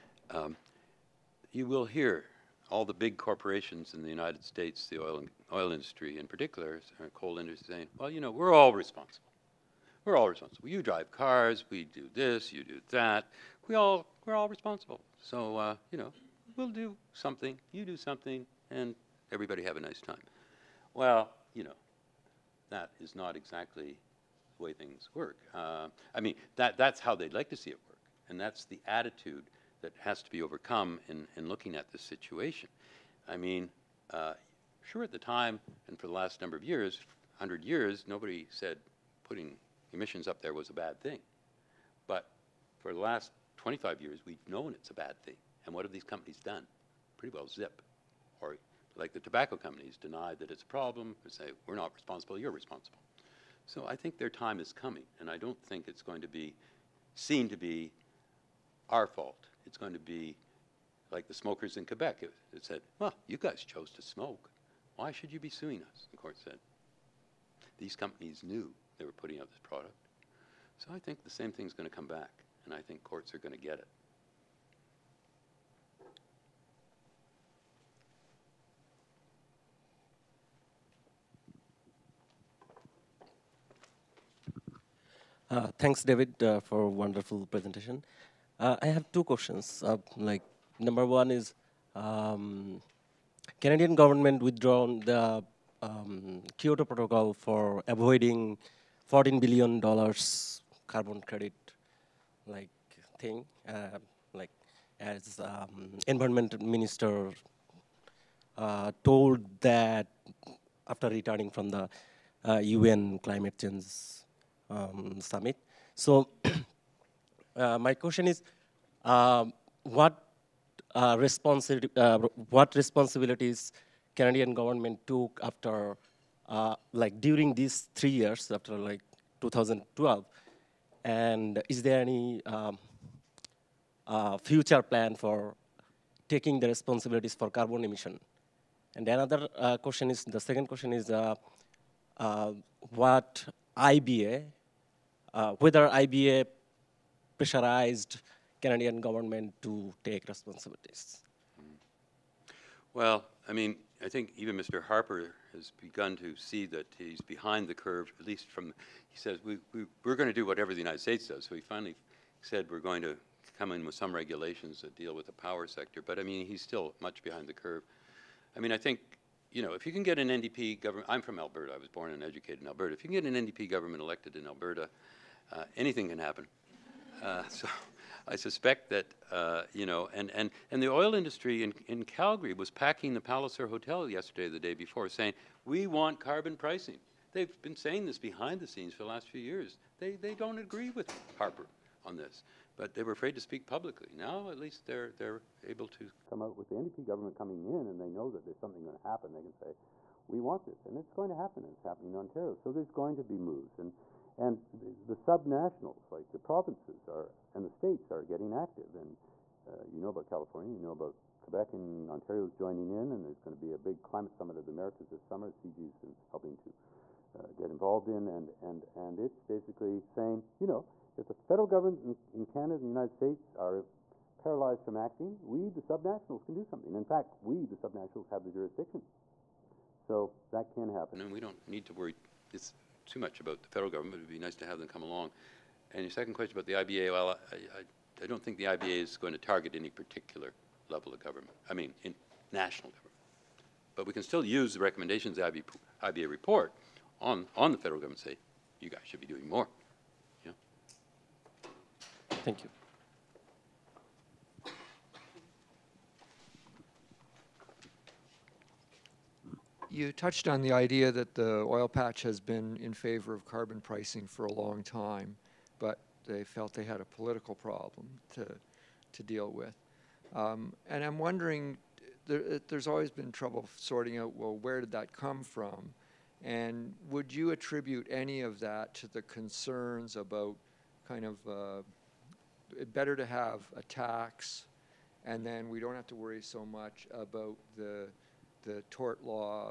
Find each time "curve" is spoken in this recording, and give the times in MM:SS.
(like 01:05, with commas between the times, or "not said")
02:37, 02:47.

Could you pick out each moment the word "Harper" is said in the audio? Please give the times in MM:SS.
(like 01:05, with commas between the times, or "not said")
02:34, 03:11.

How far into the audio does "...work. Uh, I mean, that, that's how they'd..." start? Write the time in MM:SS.
00:25.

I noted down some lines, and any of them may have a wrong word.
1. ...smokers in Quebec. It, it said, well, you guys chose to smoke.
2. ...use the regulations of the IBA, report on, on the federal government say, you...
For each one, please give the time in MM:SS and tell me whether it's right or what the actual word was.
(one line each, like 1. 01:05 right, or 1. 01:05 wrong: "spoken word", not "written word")
1. 01:01 right
2. 04:04 wrong: "recommendations", not "regulations".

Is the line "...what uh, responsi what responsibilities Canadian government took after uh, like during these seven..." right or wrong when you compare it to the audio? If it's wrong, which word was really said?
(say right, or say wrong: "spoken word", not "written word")
wrong: "three", not "seven".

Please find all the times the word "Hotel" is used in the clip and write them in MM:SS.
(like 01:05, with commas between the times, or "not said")
03:03.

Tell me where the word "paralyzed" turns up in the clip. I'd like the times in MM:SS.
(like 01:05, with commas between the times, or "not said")
03:44.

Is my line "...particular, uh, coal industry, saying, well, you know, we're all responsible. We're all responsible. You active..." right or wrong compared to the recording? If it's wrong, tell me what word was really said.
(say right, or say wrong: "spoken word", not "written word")
wrong: "drive", not "active".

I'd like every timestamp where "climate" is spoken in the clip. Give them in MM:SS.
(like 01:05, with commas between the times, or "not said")
01:53, 03:34.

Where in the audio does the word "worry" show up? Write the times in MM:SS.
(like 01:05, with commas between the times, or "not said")
03:51, 04:46.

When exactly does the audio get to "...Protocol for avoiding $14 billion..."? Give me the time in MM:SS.
01:36.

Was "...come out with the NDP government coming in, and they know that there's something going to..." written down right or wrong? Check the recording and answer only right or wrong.
right.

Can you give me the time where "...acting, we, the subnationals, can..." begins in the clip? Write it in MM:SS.
03:44.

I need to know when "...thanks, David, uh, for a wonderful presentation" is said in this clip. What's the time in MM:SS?
01:25.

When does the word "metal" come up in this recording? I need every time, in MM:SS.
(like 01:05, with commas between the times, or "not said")
not said.